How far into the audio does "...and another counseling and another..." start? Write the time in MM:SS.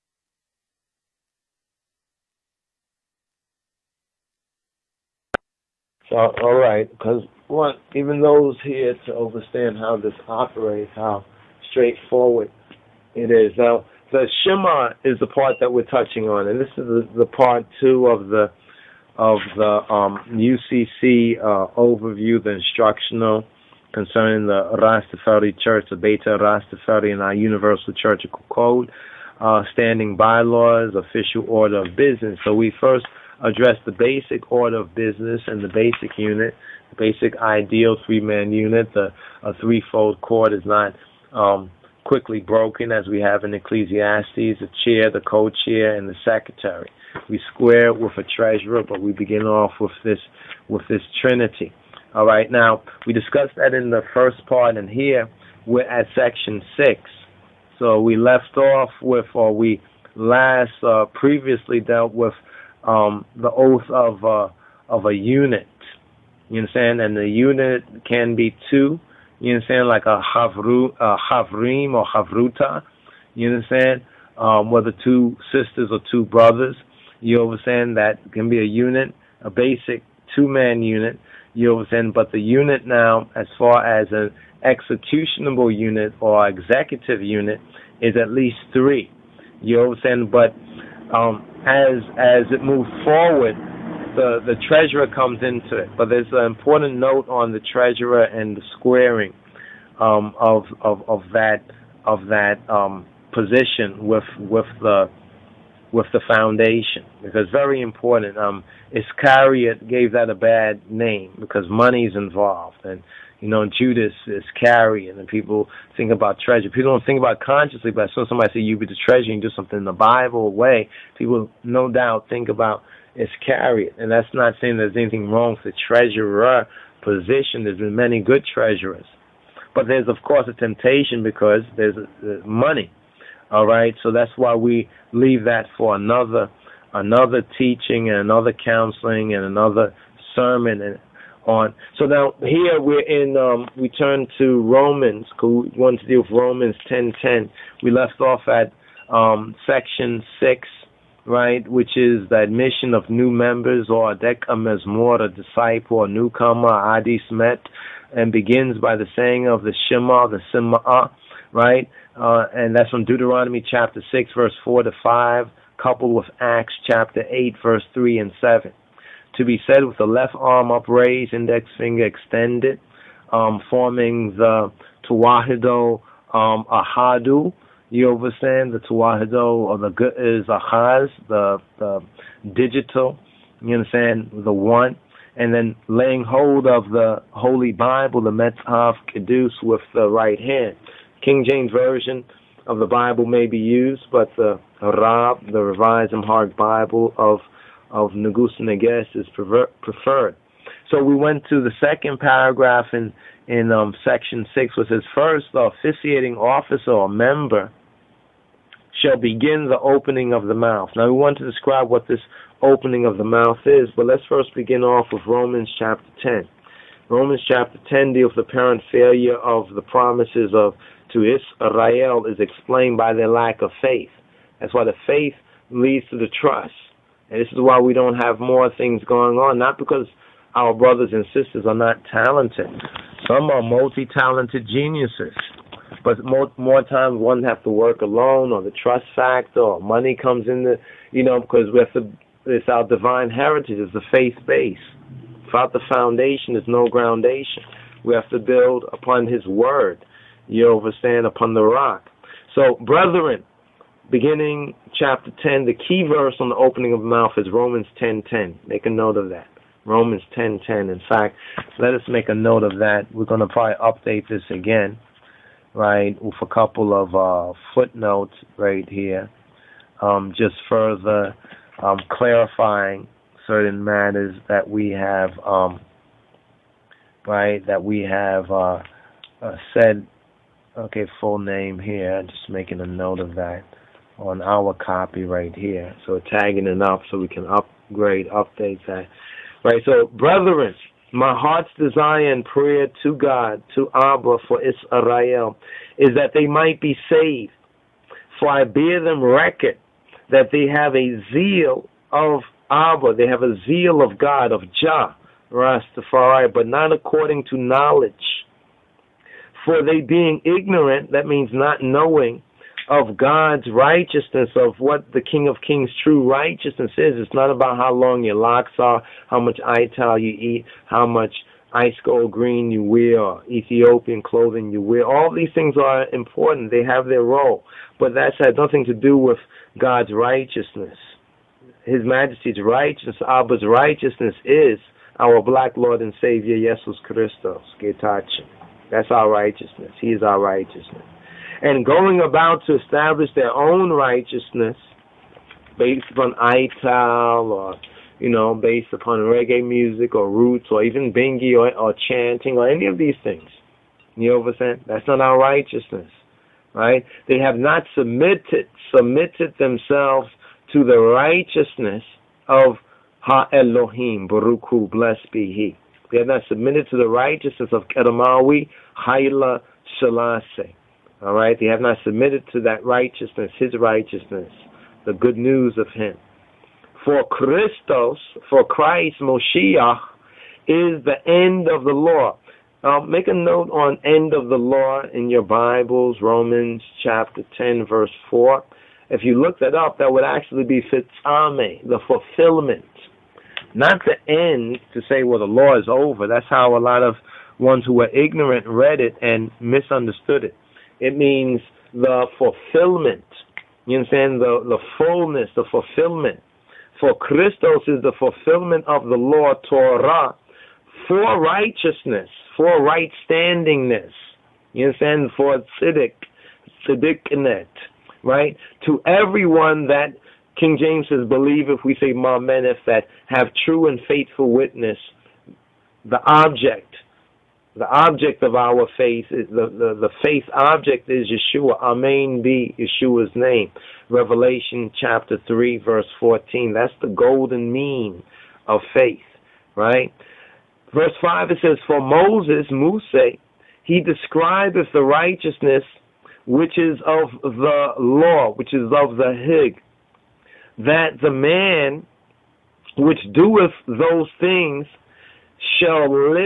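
02:18.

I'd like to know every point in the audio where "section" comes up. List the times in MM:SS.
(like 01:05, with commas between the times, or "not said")
00:56, 02:29, 03:24.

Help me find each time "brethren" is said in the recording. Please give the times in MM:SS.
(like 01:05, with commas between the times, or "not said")
04:12, 04:50.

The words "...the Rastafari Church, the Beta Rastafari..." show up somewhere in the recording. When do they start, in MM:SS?
00:24.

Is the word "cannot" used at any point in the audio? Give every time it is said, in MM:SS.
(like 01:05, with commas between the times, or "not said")
not said.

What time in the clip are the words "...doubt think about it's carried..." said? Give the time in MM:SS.
02:01.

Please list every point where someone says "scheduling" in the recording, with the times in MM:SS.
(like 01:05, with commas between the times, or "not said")
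not said.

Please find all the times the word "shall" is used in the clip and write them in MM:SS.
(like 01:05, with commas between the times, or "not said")
03:29, 07:35.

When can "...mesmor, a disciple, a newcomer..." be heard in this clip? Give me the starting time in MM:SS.
02:34.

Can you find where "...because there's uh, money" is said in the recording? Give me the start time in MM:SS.
02:11.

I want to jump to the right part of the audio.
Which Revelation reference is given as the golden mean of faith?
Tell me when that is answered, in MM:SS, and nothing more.
07:14.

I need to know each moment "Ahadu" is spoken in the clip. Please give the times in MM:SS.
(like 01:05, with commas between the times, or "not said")
02:56.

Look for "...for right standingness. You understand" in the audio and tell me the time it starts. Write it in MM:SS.
06:52.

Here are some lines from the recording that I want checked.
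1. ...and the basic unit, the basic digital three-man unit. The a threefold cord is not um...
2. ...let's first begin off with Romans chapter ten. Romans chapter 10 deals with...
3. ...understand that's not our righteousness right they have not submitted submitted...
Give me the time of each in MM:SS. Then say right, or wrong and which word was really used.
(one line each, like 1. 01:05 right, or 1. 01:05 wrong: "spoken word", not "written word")
1. 00:35 wrong: "ideal", not "digital"
2. 03:34 right
3. 05:54 right.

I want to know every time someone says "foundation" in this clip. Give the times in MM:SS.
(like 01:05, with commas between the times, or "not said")
01:46, 04:05.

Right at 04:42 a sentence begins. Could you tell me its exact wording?
Just making a note of that on our copy right here.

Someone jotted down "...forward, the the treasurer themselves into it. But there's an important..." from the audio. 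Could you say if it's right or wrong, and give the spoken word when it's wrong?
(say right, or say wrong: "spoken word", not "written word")
wrong: "comes", not "themselves".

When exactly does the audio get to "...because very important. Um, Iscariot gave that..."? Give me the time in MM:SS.
01:47.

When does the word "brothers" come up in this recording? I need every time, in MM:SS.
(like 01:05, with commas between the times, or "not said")
01:16, 03:50.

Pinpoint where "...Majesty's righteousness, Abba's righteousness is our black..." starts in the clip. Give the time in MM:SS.
05:32.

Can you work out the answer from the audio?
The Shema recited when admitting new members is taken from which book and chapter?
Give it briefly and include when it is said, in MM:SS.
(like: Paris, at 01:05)
Deuteronomy chapter 6, at 02:43.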